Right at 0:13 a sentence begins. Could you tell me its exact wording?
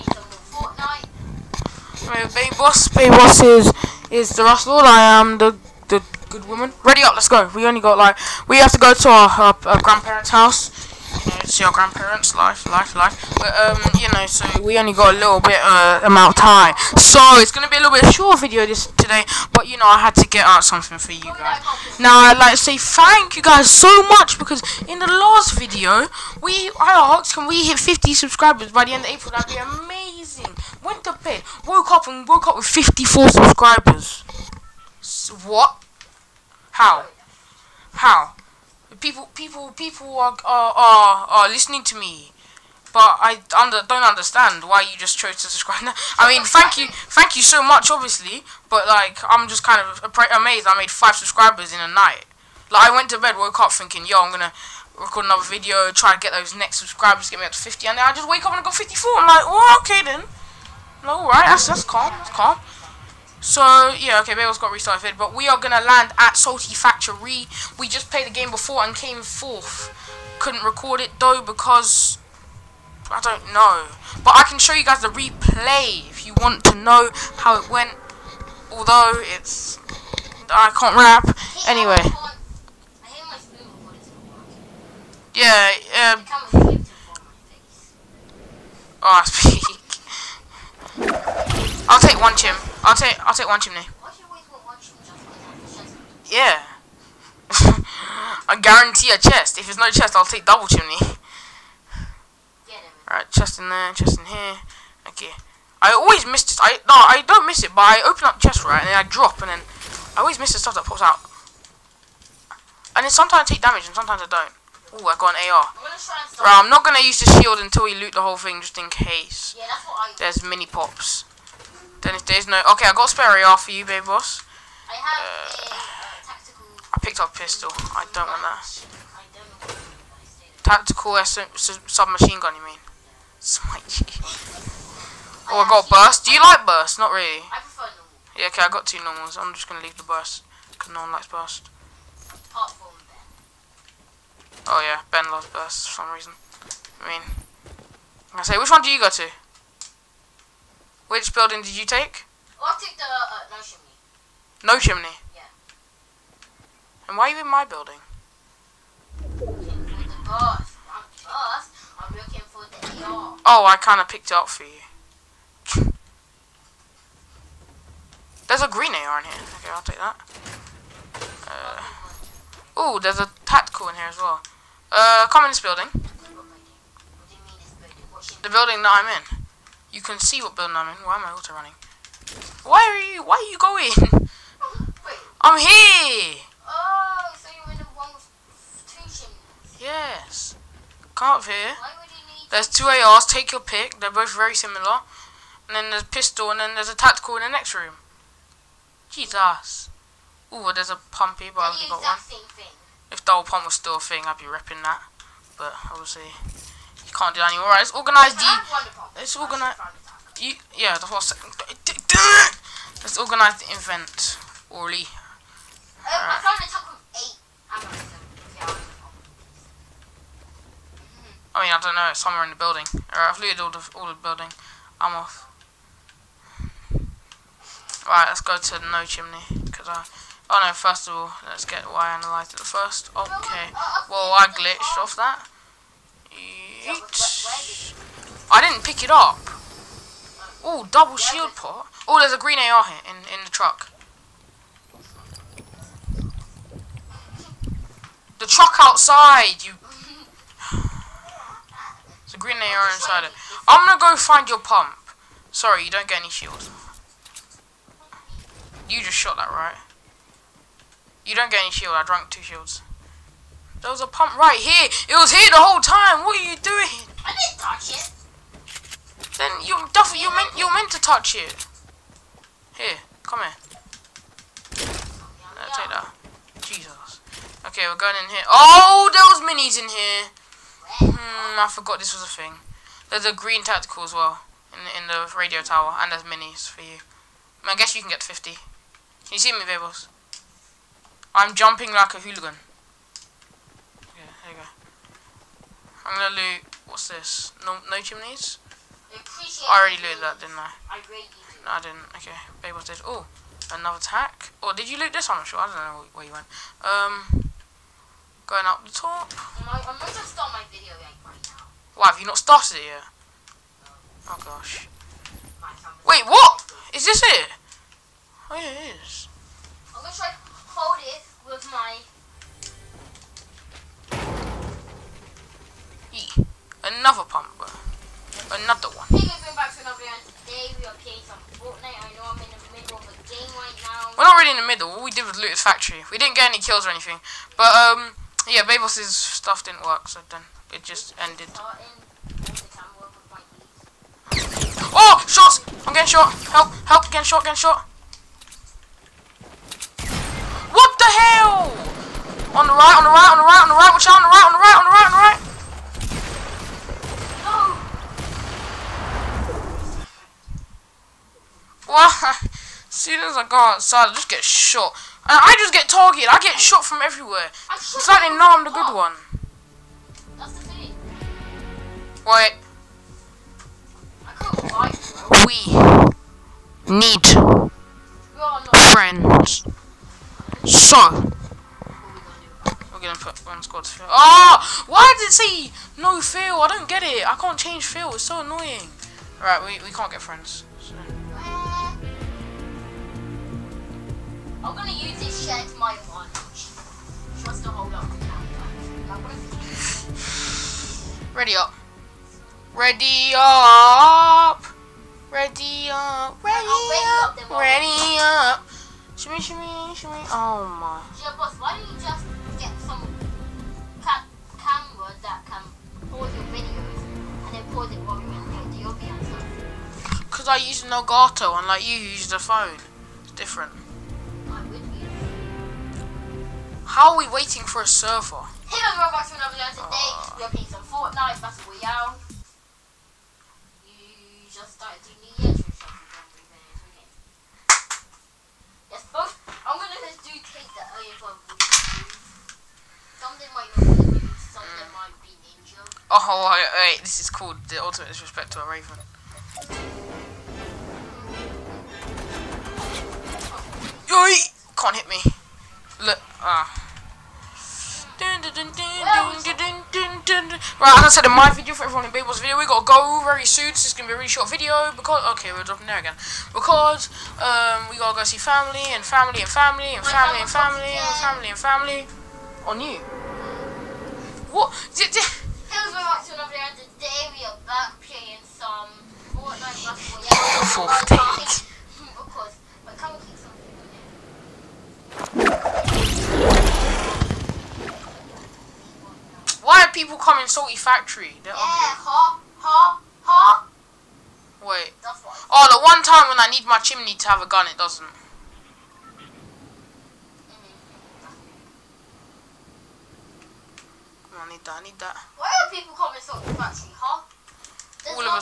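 But, um, you know, so we only got a little bit uh, amount of time.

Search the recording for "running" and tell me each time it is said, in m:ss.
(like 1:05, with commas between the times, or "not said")
3:01.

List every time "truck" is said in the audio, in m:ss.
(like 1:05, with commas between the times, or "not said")
4:03, 4:08.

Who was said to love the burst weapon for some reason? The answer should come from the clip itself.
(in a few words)
Ben.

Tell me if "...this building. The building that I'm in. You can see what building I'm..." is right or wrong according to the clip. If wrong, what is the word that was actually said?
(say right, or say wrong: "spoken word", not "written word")
right.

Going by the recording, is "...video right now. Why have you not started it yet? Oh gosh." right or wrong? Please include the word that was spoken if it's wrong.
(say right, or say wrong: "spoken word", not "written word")
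right.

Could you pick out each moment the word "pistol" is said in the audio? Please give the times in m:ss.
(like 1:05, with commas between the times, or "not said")
2:07, 3:16.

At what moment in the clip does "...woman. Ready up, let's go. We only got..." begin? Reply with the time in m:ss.
0:06.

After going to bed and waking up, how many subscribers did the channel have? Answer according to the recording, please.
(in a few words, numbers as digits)
54.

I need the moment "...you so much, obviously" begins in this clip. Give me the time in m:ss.
0:47.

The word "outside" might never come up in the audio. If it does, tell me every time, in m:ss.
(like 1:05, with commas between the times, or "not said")
4:08, 6:03.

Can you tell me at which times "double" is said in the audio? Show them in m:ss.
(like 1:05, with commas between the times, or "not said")
1:40, 4:00.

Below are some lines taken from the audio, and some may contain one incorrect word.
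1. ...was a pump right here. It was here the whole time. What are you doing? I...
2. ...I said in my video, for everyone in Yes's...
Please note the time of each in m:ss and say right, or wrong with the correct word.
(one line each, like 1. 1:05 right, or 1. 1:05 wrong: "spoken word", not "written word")
1. 4:23 right
2. 7:41 wrong: "Babel", not "Yes".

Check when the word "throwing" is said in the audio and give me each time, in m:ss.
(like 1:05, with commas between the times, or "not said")
not said.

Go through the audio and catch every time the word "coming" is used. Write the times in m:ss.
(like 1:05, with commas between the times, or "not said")
8:10, 8:25.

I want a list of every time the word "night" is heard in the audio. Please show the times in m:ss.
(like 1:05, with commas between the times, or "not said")
0:51.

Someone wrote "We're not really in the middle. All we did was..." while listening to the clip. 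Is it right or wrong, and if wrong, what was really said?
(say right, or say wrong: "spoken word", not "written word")
right.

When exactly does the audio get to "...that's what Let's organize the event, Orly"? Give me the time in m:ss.
3:30.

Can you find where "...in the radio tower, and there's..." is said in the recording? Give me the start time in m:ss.
4:44.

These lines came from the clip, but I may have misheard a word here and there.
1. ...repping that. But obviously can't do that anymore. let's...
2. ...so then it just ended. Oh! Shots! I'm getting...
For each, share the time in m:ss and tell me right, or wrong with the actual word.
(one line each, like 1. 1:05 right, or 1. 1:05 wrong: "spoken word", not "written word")
1. 3:24 right
2. 5:40 right.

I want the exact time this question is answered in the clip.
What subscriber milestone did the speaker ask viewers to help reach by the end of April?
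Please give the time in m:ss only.
0:27.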